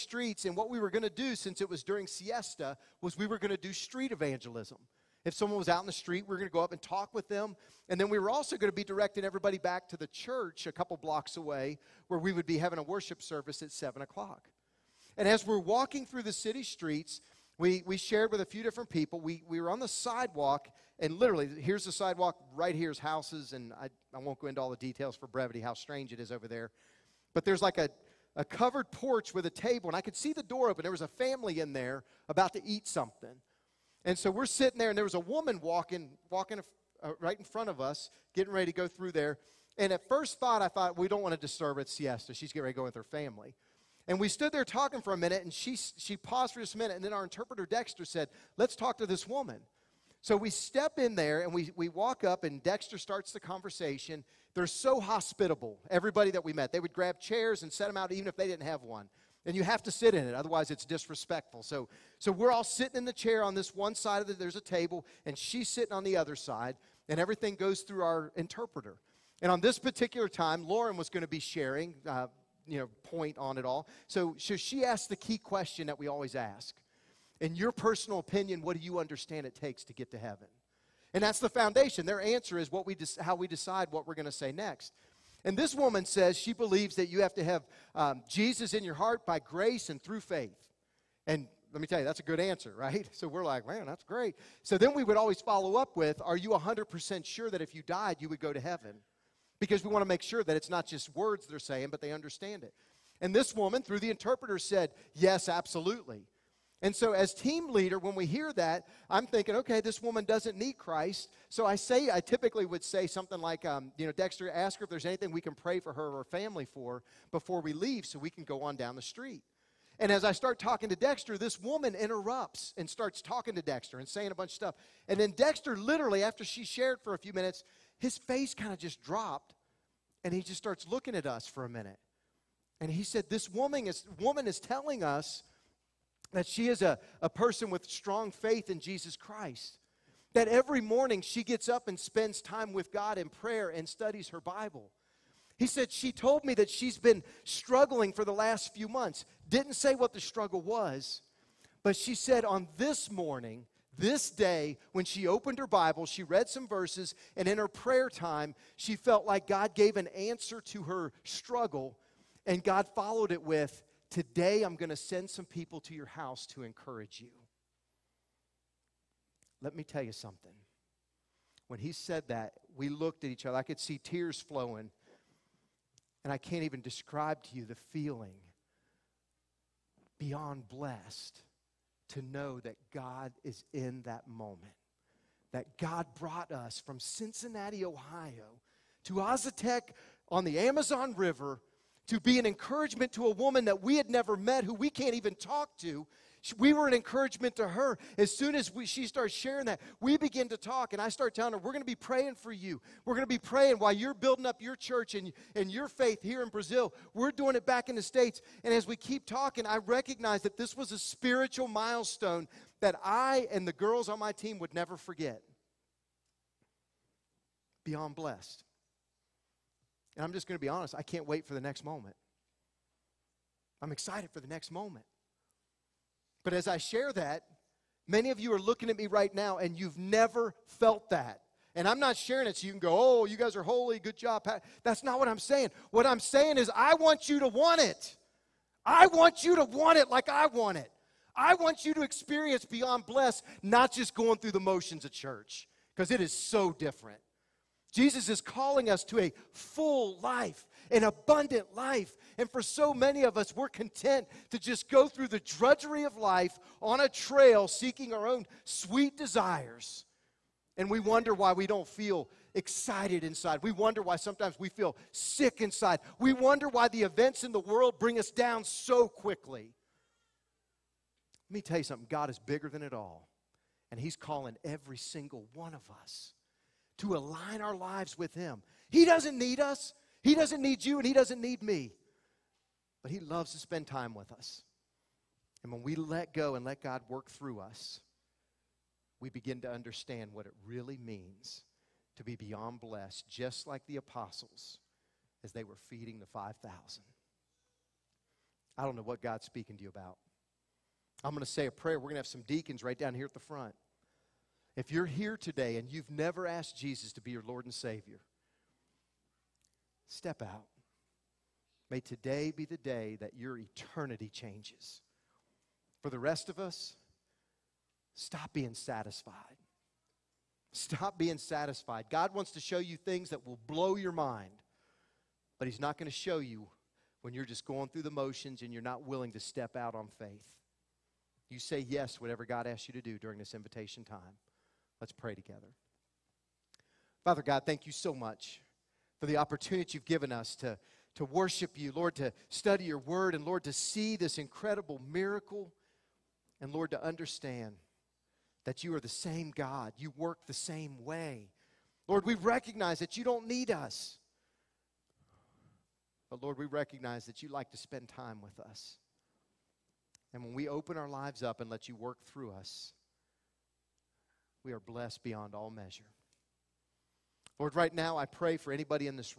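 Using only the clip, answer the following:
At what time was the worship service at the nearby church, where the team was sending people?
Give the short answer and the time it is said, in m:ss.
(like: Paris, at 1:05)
7 o'clock, at 0:13.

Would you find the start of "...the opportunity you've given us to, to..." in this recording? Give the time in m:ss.
5:39.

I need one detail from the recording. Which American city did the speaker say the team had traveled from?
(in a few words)
Cincinnati, Ohio.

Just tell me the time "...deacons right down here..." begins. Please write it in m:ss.
5:02.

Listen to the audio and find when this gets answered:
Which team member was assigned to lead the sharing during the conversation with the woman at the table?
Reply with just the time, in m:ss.
1:10.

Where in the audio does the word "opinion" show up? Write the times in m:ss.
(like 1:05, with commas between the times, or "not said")
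1:18.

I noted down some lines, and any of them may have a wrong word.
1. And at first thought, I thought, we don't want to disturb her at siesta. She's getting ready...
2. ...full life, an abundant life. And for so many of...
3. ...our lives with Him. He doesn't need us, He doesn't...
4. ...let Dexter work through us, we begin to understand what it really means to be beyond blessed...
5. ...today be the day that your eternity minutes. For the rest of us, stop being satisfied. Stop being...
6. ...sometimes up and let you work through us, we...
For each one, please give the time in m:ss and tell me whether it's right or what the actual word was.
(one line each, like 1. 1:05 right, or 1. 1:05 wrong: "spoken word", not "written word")
1. 0:39 right
2. 4:09 right
3. 4:37 right
4. 4:46 wrong: "God", not "Dexter"
5. 5:11 wrong: "changes", not "minutes"
6. 6:01 wrong: "lives", not "sometimes".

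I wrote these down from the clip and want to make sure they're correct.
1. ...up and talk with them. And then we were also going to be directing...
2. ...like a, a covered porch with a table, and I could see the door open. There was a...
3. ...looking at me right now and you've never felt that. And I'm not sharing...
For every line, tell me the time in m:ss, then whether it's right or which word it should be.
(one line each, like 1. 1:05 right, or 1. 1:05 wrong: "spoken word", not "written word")
1. 0:06 right
2. 0:27 right
3. 3:48 right.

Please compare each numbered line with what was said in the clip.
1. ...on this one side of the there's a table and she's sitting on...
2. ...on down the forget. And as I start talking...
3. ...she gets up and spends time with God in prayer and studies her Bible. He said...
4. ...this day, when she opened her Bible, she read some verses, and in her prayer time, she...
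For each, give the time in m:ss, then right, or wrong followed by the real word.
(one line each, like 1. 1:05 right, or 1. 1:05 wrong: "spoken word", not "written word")
1. 1:03 right
2. 1:58 wrong: "street", not "forget"
3. 2:21 right
4. 2:33 right.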